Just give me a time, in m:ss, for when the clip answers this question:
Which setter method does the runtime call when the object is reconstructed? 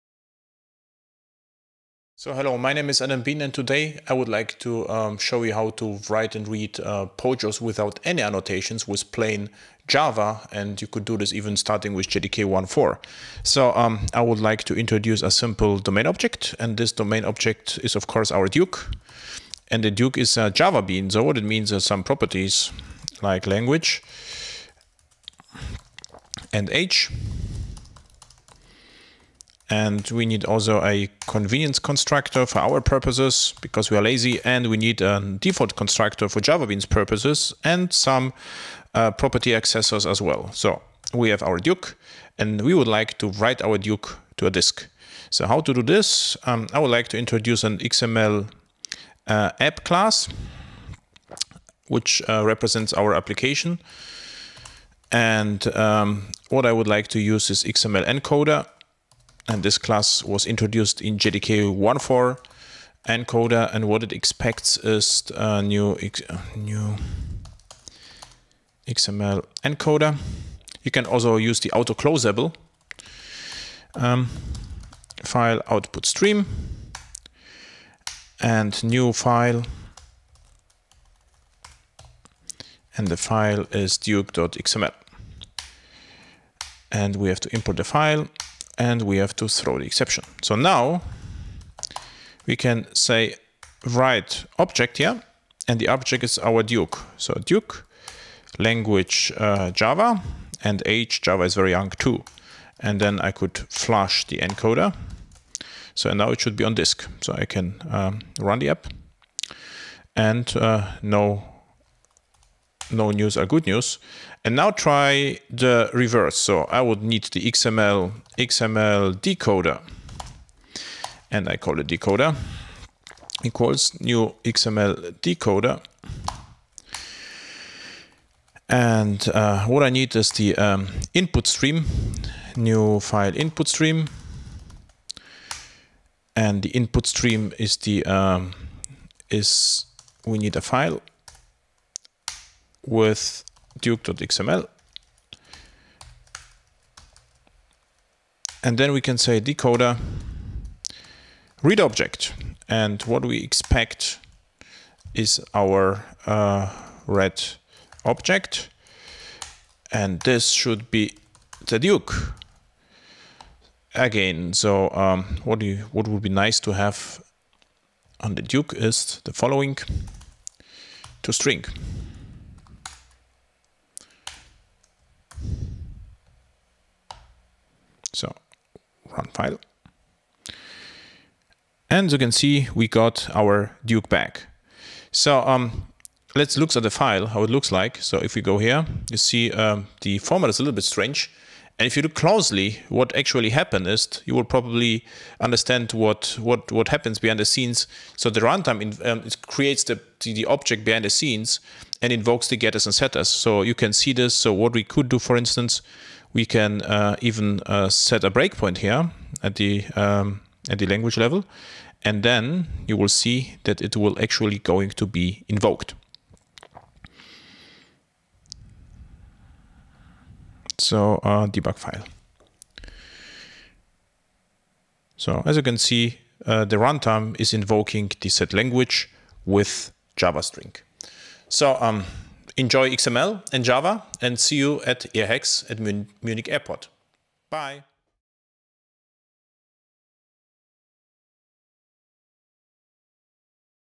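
3:48.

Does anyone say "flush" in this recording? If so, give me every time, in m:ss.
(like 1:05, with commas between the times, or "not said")
1:43.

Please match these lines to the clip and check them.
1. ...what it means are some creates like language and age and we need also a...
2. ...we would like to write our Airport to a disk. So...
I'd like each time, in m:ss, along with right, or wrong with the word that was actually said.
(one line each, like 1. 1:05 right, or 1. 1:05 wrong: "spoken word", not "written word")
1. 0:21 wrong: "properties", not "creates"
2. 0:42 wrong: "Duke", not "Airport".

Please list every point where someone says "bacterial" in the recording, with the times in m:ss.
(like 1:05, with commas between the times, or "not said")
not said.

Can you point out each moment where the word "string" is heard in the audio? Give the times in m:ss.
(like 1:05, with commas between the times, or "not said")
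2:51, 3:50.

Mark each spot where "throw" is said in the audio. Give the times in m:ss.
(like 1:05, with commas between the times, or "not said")
1:29.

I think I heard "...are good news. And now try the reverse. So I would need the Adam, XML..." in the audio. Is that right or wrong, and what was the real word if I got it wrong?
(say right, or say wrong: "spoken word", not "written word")
wrong: "XML", not "Adam".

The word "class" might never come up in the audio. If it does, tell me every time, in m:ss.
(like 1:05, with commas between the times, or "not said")
0:49, 0:59.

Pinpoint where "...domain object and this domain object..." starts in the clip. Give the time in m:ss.
0:15.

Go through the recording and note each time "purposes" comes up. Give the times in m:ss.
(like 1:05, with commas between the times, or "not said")
0:32, 0:36.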